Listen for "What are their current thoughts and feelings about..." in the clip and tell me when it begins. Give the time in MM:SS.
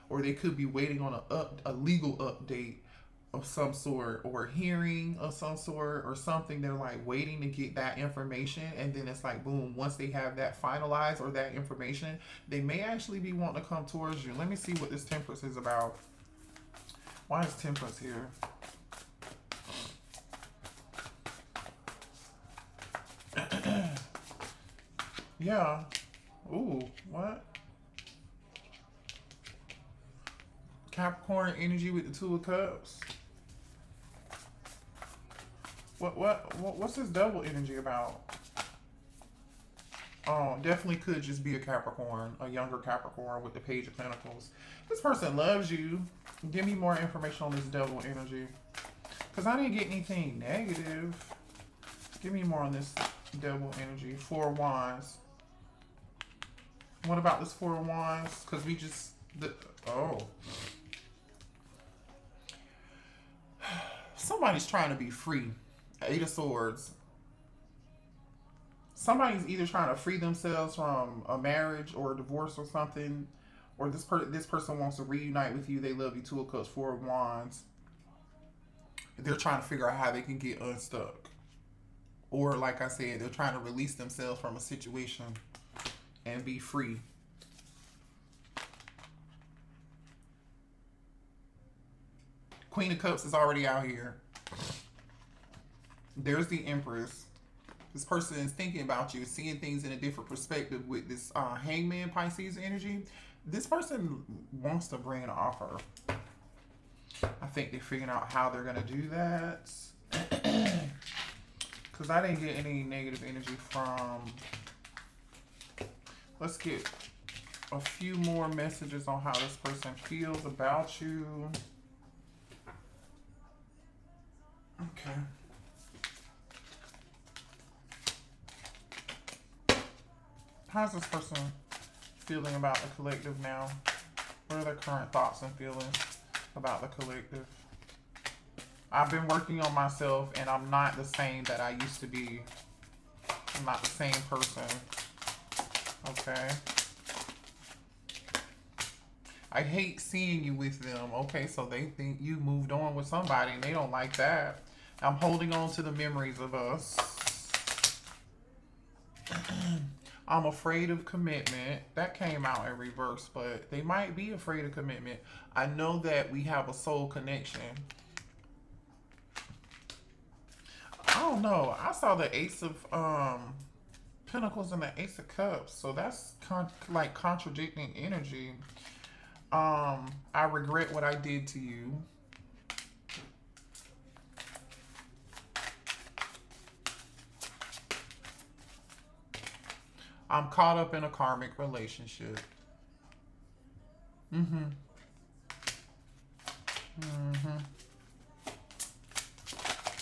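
02:14.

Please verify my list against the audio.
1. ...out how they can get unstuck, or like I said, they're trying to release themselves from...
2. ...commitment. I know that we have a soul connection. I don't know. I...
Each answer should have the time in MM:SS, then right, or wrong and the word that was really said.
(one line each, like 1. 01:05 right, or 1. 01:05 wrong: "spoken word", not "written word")
1. 01:19 right
2. 02:44 right.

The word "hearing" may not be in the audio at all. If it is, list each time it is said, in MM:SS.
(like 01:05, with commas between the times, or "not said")
00:04.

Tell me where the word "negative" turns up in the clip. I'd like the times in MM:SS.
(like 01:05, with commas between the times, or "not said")
00:50, 01:52.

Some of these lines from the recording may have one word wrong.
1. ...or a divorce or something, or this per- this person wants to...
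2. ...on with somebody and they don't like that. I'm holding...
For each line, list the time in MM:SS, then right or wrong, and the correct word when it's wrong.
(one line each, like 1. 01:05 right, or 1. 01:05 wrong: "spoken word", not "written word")
1. 01:11 right
2. 02:32 right.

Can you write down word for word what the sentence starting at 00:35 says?
What what, what's this double energy about?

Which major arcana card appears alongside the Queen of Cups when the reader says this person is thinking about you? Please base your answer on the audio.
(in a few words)
The Empress.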